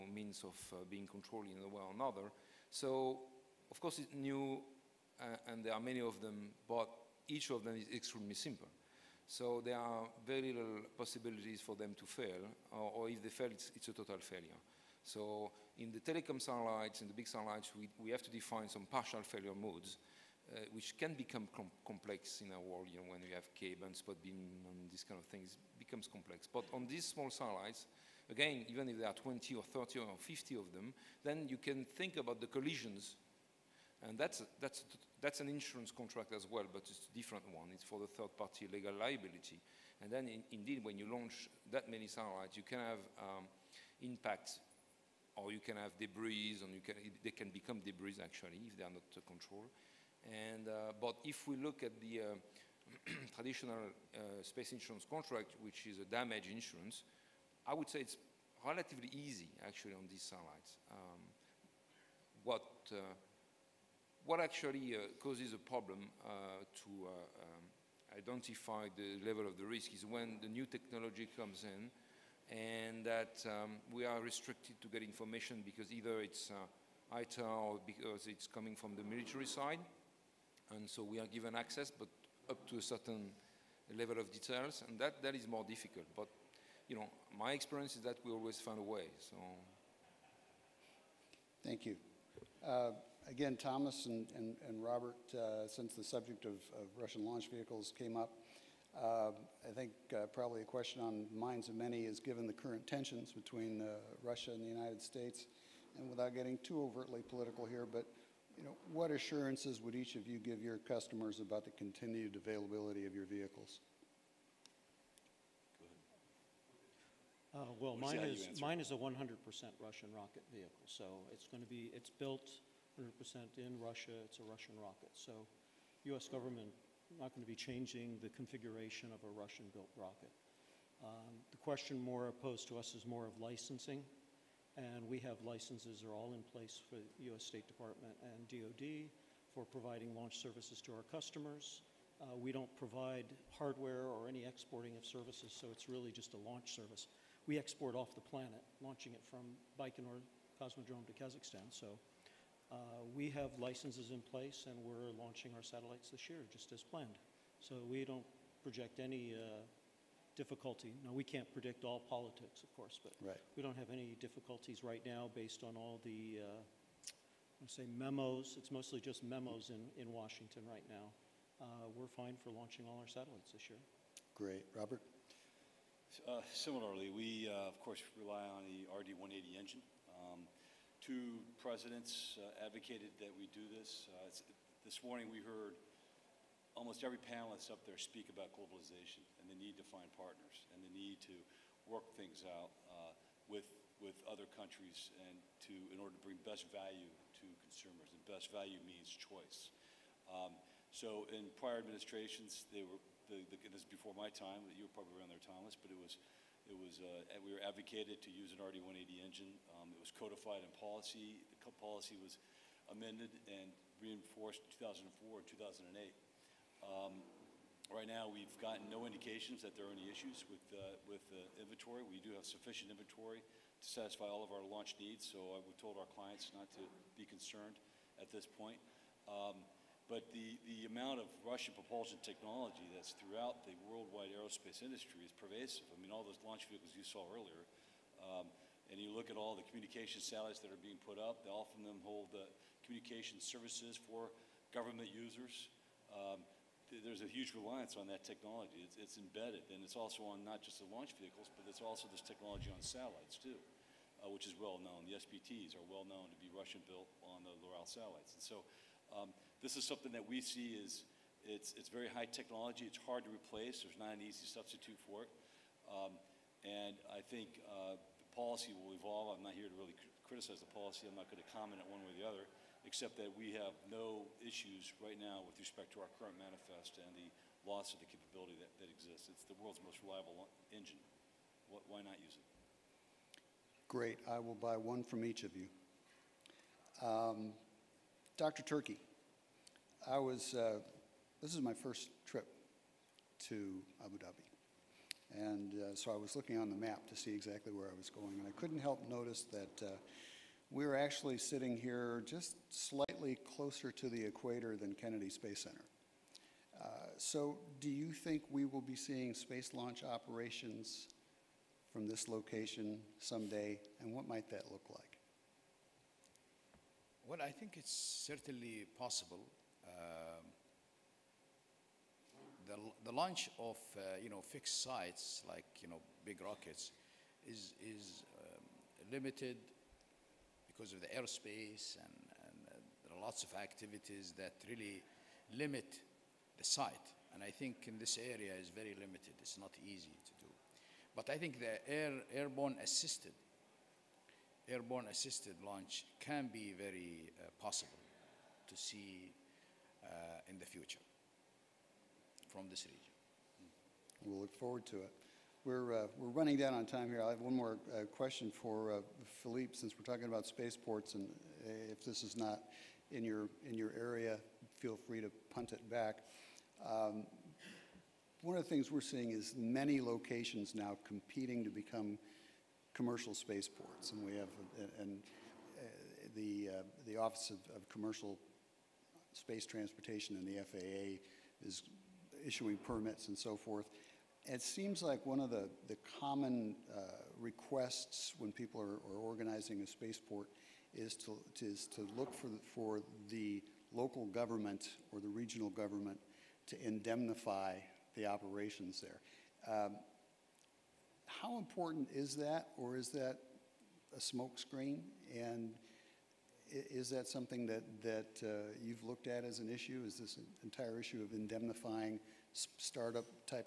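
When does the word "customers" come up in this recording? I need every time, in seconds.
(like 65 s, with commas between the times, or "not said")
110 s, 141 s.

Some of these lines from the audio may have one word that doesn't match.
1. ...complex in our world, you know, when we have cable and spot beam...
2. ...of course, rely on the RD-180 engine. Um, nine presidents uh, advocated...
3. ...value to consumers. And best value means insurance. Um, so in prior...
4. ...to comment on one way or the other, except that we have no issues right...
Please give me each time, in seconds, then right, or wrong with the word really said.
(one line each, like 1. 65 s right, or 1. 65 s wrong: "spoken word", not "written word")
1. 21 s right
2. 177 s wrong: "two", not "nine"
3. 196 s wrong: "choice", not "insurance"
4. 271 s right.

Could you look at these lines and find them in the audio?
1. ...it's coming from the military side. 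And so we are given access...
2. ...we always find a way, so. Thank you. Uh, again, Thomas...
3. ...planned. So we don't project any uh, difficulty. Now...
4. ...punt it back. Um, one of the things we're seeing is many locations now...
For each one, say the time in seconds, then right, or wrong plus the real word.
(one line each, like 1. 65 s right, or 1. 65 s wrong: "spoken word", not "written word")
1. 78 s right
2. 88 s right
3. 156 s right
4. 365 s right.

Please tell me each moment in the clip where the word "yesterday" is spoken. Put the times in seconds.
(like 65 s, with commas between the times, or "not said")
not said.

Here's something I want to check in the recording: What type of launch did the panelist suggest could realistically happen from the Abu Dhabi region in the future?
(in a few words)
airborne assisted launch.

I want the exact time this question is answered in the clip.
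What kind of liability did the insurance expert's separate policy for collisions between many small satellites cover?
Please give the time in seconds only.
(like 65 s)
38 s.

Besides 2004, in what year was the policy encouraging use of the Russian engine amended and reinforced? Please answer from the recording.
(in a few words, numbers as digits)
2008.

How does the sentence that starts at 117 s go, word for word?
Uh, well, mine is, mine is a 100% Russian rocket vehicle, so it's going to be, it's built 100% in Russia.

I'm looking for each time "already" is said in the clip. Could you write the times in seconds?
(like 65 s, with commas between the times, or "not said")
not said.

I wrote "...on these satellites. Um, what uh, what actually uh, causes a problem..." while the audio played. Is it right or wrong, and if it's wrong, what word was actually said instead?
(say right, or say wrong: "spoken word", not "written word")
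right.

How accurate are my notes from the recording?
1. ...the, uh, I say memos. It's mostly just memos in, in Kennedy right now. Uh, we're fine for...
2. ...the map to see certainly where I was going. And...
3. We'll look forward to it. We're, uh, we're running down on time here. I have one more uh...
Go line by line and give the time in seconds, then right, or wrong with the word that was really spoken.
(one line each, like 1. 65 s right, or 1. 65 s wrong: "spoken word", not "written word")
1. 166 s wrong: "Washington", not "Kennedy"
2. 296 s wrong: "exactly", not "certainly"
3. 354 s right.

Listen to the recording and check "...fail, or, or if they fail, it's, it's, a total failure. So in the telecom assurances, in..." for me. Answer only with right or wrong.
wrong.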